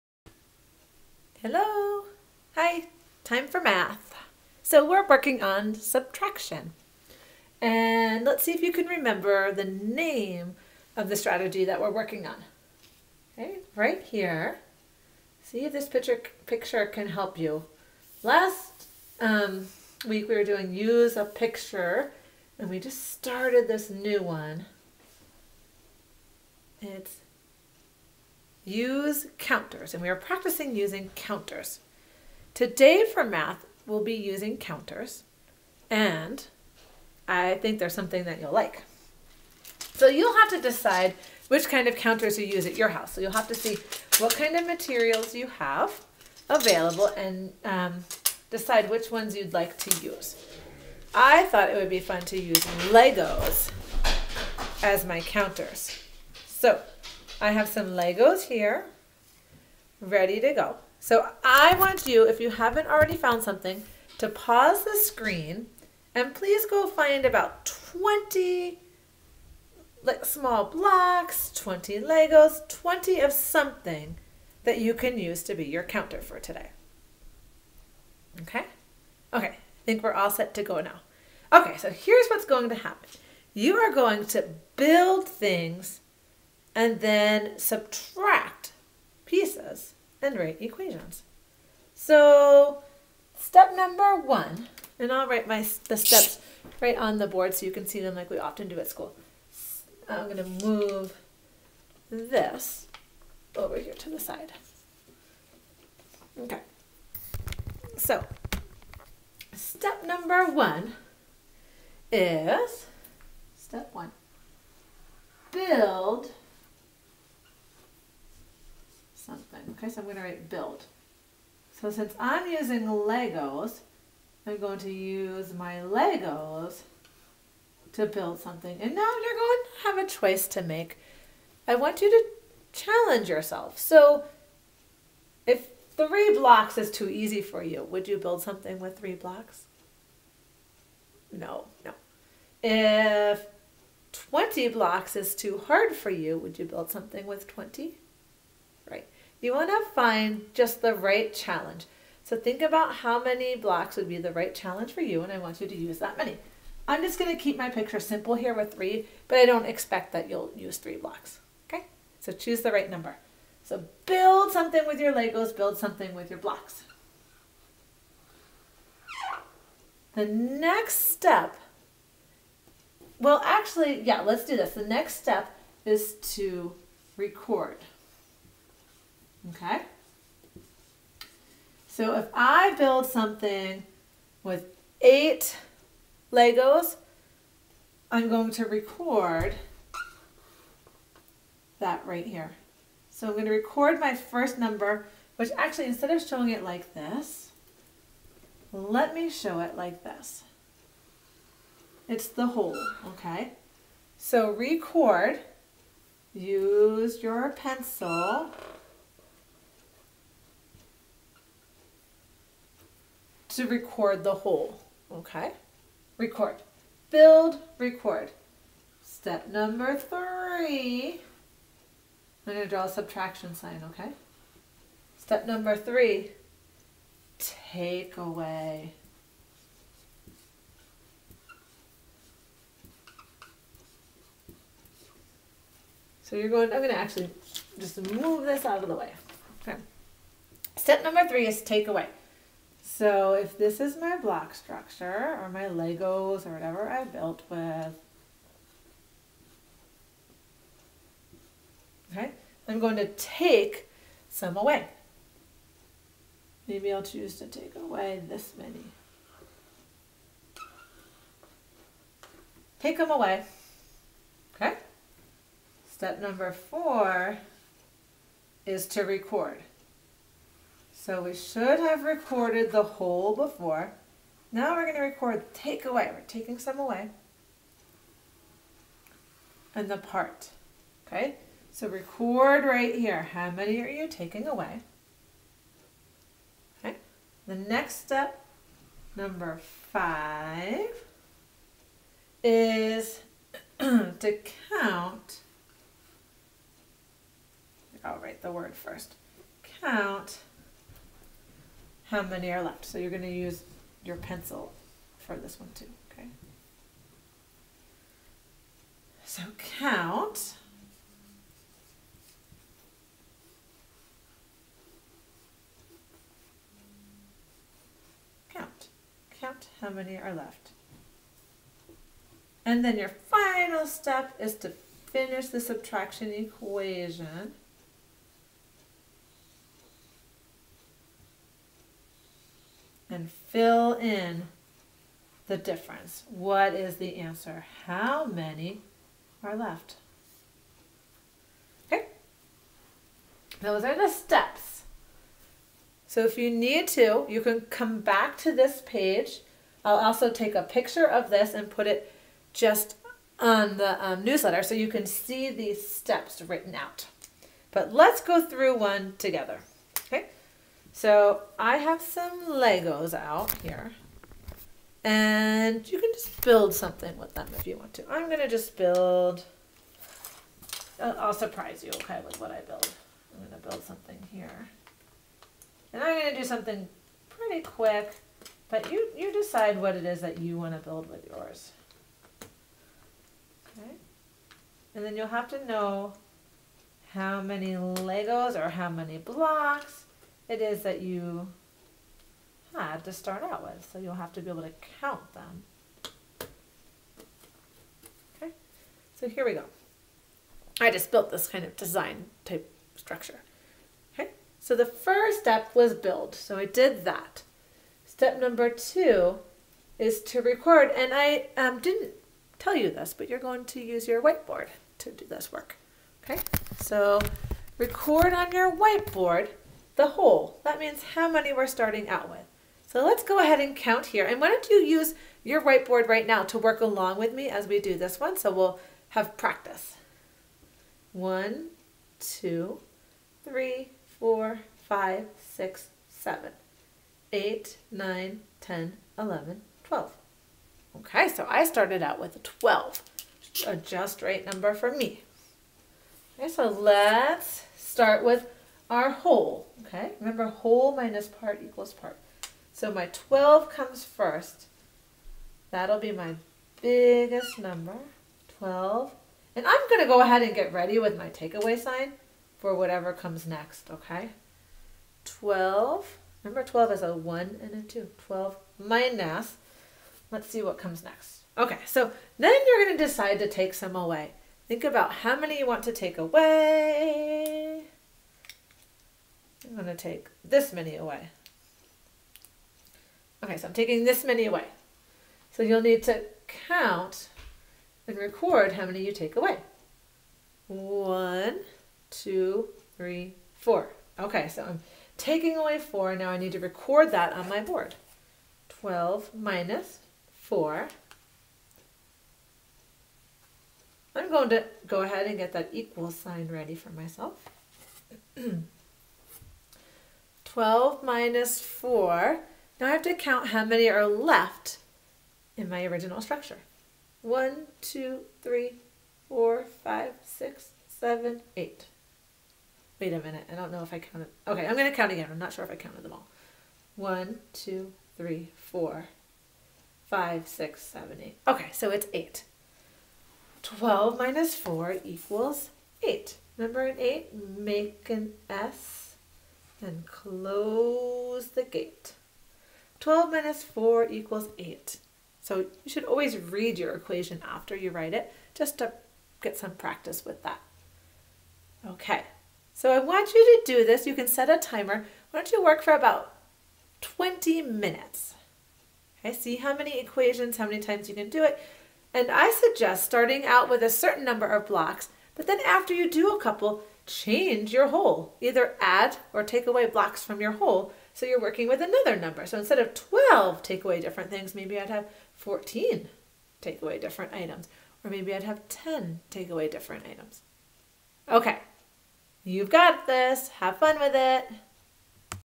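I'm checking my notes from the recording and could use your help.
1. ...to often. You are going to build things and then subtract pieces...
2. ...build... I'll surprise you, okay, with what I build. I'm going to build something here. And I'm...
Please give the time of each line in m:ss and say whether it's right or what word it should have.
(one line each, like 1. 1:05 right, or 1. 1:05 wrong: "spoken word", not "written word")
1. 1:22 wrong: "happen", not "often"
2. 6:08 right.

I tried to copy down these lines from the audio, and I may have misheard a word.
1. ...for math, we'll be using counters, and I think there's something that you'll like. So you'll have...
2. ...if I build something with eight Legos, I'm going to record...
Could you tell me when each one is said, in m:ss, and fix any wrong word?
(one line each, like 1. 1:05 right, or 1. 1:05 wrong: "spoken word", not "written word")
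1. 0:33 right
2. 3:02 right.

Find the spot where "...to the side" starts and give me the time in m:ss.
1:43.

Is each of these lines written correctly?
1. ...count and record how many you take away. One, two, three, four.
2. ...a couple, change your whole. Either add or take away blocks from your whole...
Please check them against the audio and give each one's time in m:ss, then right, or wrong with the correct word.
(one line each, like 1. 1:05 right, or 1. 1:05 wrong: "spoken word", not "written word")
1. 8:06 right
2. 9:26 right.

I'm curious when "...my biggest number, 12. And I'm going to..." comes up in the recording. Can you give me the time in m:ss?
7:36.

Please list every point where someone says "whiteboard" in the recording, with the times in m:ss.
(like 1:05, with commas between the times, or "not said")
6:54, 6:58, 7:05.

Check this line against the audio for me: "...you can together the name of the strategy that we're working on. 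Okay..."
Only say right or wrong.
wrong.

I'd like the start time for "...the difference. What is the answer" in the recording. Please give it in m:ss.
5:35.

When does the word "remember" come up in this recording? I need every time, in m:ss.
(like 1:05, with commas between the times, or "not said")
0:08, 7:30, 7:46, 8:56.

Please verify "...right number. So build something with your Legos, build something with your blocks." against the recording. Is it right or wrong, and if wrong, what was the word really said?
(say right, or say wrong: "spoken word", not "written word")
right.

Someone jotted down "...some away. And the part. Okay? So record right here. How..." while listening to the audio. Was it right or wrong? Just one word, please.
right.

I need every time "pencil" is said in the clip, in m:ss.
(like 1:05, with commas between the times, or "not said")
3:27, 5:04.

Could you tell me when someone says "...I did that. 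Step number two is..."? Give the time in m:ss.
6:46.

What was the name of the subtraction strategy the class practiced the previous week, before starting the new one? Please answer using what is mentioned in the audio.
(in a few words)
Use a picture.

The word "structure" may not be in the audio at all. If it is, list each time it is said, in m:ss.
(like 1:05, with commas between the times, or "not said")
4:04, 6:42, 8:36.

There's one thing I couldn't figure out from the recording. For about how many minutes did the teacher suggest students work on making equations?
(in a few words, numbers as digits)
20.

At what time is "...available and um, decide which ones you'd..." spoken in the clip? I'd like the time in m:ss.
0:46.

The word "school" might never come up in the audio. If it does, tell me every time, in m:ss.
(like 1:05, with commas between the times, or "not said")
1:38.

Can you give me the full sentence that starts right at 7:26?
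Okay, so let's start with our whole, okay?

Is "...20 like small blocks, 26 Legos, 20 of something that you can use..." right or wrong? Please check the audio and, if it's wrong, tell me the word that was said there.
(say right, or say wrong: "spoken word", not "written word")
wrong: "20", not "26".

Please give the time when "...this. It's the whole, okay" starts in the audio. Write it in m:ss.
3:20.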